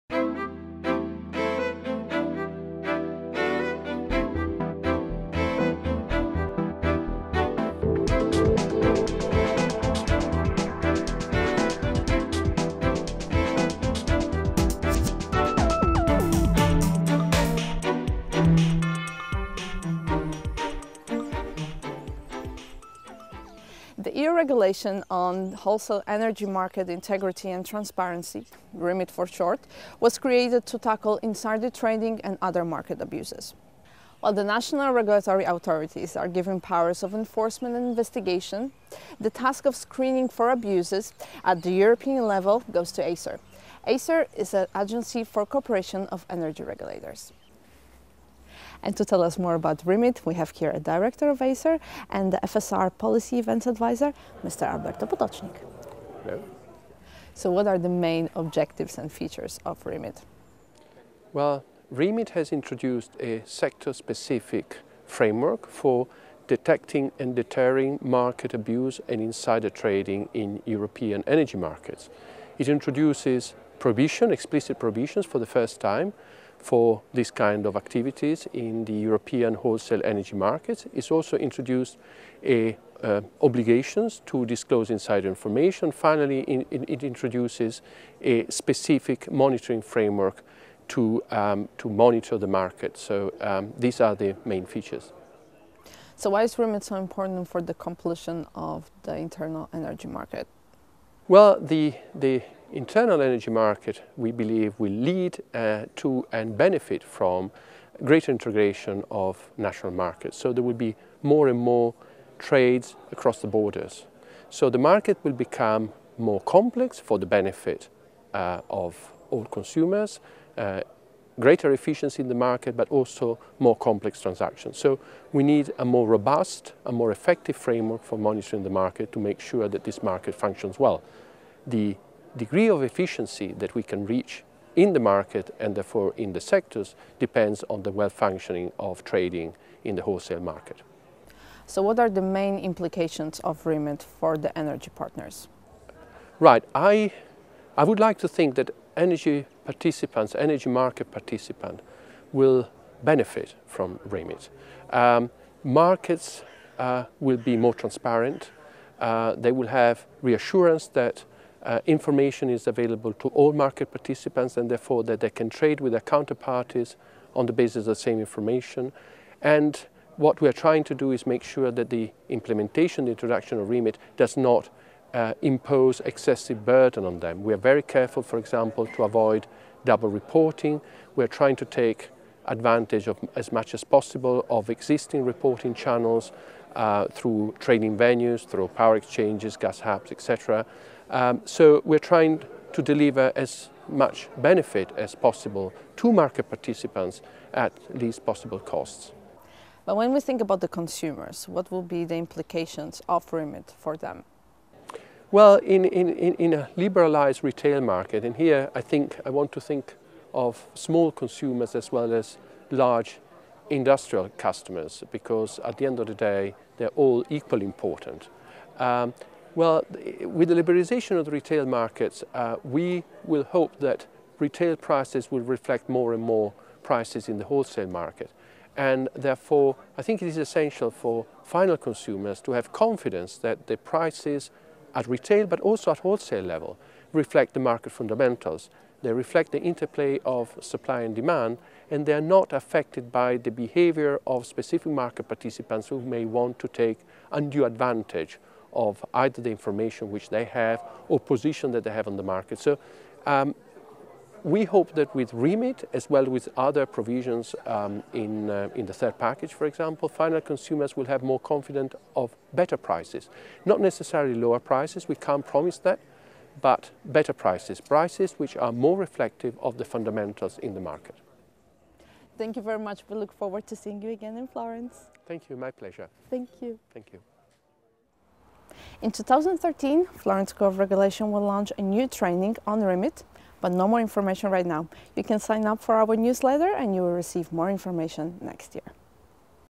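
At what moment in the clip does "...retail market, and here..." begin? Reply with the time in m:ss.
3:27.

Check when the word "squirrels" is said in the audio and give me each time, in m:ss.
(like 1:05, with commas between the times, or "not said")
not said.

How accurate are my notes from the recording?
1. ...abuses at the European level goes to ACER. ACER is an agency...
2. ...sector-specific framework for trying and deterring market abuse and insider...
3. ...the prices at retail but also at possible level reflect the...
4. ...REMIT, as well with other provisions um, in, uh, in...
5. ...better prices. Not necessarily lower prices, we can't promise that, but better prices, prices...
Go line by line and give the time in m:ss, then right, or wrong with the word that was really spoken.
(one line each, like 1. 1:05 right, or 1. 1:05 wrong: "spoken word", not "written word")
1. 0:40 right
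2. 1:03 wrong: "detecting", not "trying"
3. 3:53 wrong: "wholesale", not "possible"
4. 4:15 right
5. 4:22 right.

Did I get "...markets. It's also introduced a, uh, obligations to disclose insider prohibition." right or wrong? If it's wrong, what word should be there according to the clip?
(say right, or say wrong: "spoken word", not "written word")
wrong: "information", not "prohibition".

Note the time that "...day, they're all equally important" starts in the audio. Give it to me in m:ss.
3:36.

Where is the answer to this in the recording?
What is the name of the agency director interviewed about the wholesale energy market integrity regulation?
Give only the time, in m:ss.
0:54.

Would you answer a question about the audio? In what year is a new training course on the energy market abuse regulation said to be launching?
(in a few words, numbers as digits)
2013.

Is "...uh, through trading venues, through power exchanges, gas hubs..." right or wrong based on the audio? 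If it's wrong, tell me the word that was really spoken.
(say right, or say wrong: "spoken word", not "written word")
right.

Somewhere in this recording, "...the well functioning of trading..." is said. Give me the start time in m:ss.
2:17.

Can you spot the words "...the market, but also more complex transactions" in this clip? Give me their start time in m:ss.
2:02.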